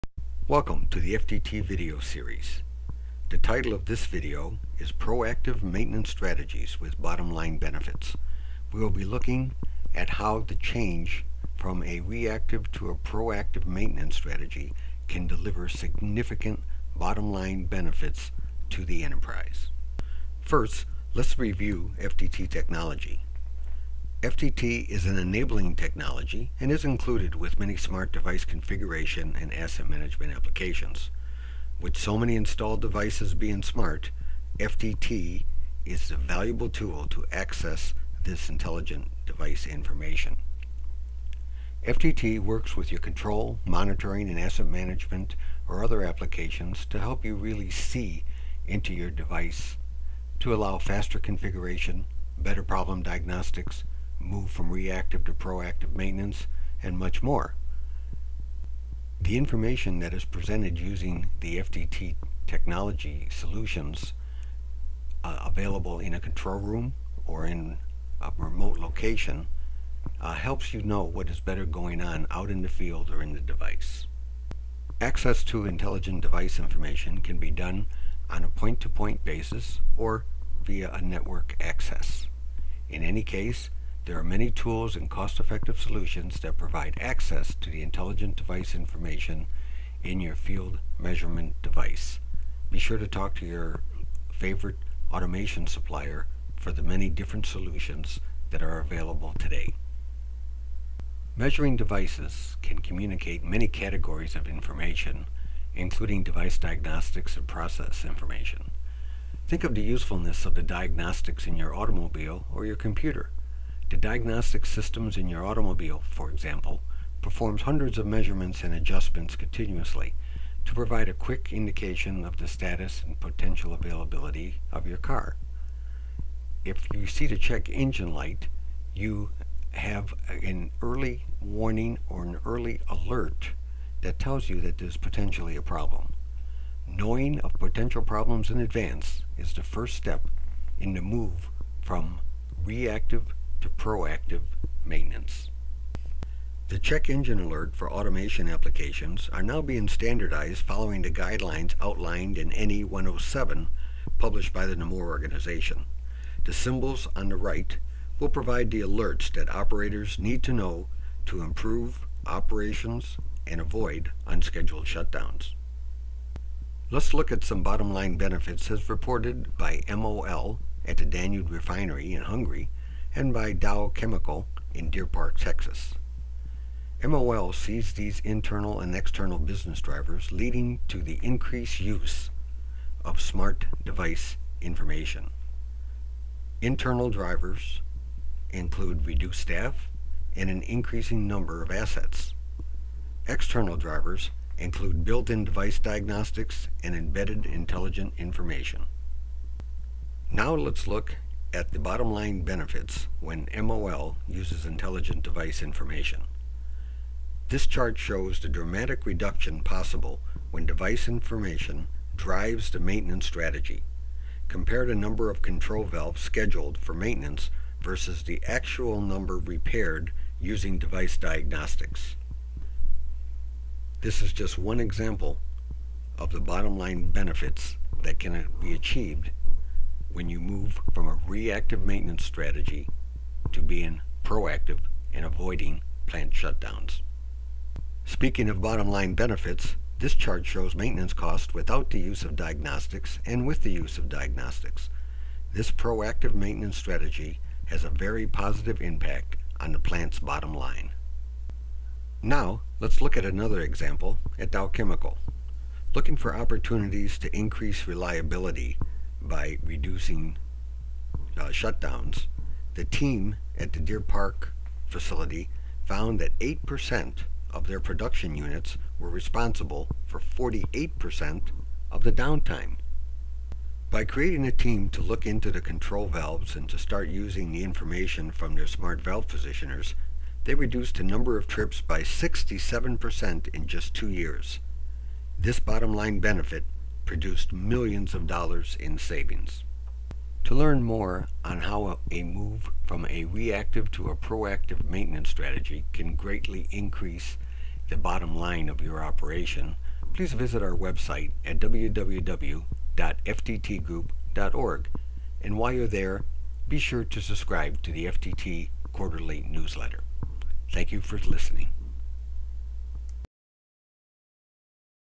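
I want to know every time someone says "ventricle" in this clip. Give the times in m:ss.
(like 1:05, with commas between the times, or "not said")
not said.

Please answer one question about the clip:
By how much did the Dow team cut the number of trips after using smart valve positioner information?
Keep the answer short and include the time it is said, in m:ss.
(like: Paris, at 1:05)
67%, at 4:42.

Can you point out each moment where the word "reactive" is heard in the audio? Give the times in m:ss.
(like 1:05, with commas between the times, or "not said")
0:12, 0:54, 2:22, 3:51, 4:53.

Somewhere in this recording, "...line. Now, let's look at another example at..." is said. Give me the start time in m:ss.
4:10.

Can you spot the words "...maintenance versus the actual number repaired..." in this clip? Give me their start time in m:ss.
3:36.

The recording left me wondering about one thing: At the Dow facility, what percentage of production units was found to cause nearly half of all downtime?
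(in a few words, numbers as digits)
8%.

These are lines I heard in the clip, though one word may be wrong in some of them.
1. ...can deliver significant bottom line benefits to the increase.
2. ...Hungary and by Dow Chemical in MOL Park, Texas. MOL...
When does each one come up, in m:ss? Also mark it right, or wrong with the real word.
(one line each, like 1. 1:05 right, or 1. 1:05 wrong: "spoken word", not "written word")
1. 0:15 wrong: "enterprise", not "increase"
2. 2:52 wrong: "Deer", not "MOL".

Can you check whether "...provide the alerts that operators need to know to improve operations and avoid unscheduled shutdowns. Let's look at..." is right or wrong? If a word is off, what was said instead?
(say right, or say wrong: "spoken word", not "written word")
right.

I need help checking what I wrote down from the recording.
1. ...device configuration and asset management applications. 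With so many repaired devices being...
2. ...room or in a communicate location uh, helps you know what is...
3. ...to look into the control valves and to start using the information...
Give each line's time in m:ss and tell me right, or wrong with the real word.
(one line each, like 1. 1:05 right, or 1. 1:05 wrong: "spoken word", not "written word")
1. 0:28 wrong: "installed", not "repaired"
2. 1:06 wrong: "remote", not "communicate"
3. 4:34 right.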